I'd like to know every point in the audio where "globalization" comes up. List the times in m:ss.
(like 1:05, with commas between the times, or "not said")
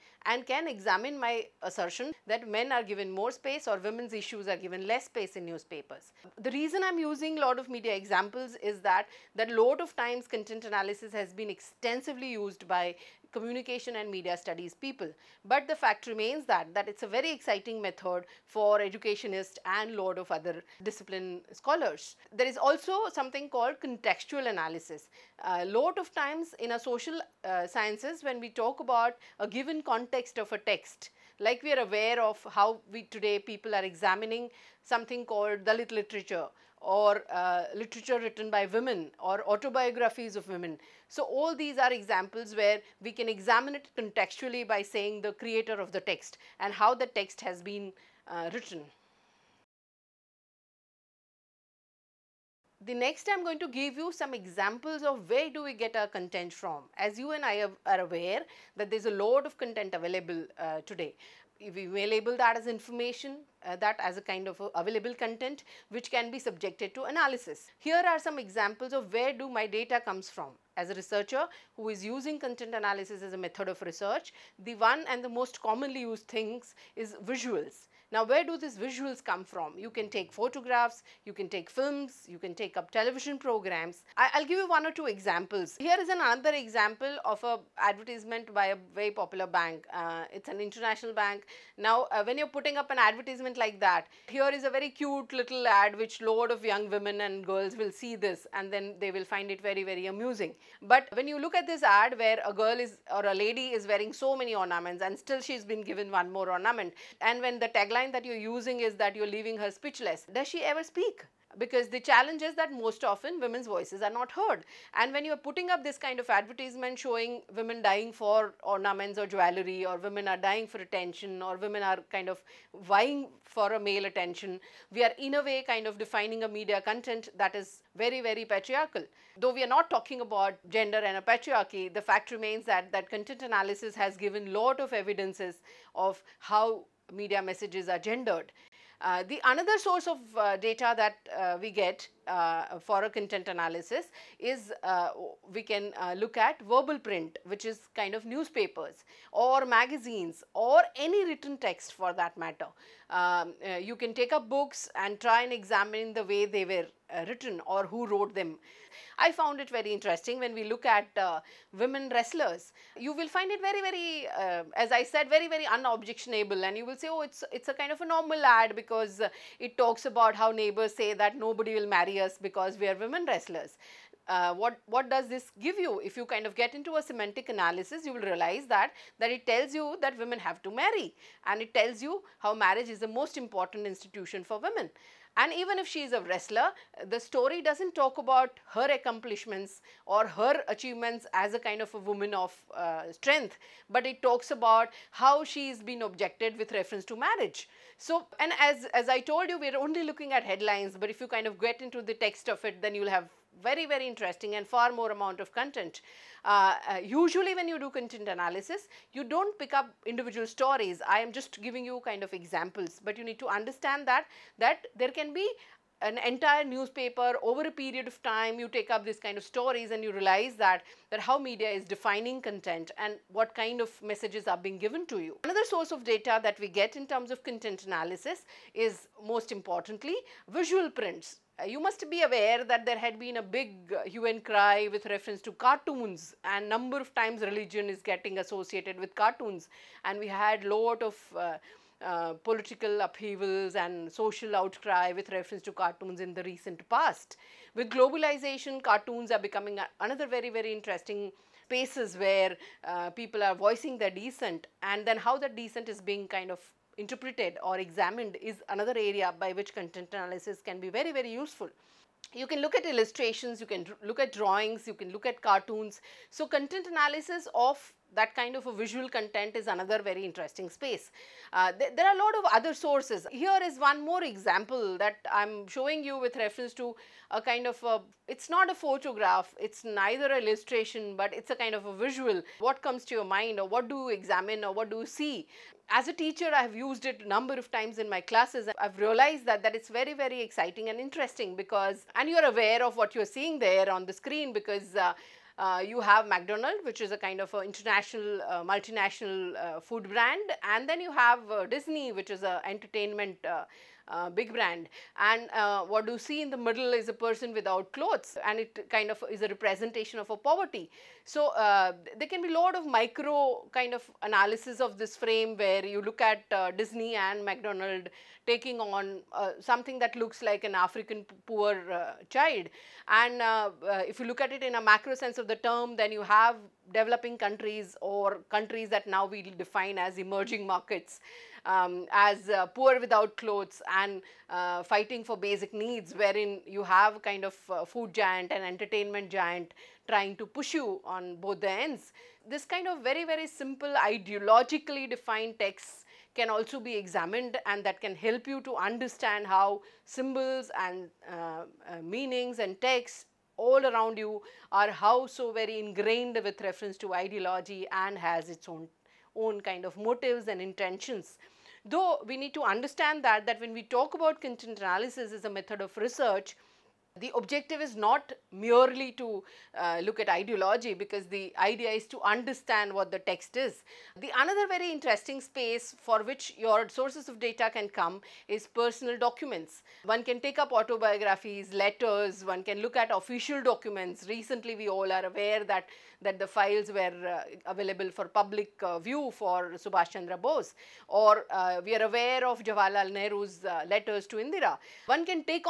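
4:07.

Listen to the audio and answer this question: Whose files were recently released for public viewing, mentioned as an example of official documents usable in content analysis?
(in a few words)
Subhash Chandra Bose.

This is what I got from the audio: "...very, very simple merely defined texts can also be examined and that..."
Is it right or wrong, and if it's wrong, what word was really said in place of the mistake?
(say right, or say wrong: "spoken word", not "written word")
wrong: "ideologically", not "merely".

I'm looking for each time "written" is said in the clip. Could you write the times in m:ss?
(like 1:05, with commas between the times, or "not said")
0:38, 0:48, 2:31, 2:37.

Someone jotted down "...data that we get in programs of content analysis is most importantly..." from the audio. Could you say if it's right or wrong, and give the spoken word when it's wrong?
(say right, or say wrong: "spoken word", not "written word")
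wrong: "terms", not "programs".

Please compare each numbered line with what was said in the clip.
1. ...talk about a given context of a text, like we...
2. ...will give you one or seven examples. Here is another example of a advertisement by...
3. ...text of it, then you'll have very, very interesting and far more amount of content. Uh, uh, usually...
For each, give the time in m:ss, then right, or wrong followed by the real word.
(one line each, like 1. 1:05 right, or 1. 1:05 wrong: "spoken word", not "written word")
1. 0:28 right
2. 1:24 wrong: "two", not "seven"
3. 3:22 right.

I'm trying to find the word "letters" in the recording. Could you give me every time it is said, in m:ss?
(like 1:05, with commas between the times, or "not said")
6:21, 6:33.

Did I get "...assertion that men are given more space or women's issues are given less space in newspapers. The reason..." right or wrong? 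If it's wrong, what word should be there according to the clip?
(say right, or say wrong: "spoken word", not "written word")
right.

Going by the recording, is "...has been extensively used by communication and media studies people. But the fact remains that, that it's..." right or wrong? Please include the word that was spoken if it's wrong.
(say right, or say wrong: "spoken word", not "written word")
right.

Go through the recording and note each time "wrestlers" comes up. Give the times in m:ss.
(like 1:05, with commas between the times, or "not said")
2:42, 2:53, 3:06.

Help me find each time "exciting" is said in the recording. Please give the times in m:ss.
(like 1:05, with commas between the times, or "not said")
0:17, 4:50.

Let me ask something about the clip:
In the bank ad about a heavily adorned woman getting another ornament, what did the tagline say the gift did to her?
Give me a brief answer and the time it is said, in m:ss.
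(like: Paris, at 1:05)
leaving her speechless, at 1:49.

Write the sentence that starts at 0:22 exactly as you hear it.
There is also something called contextual analysis.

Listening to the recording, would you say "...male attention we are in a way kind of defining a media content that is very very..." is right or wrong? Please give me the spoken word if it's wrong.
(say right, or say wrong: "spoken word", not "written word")
right.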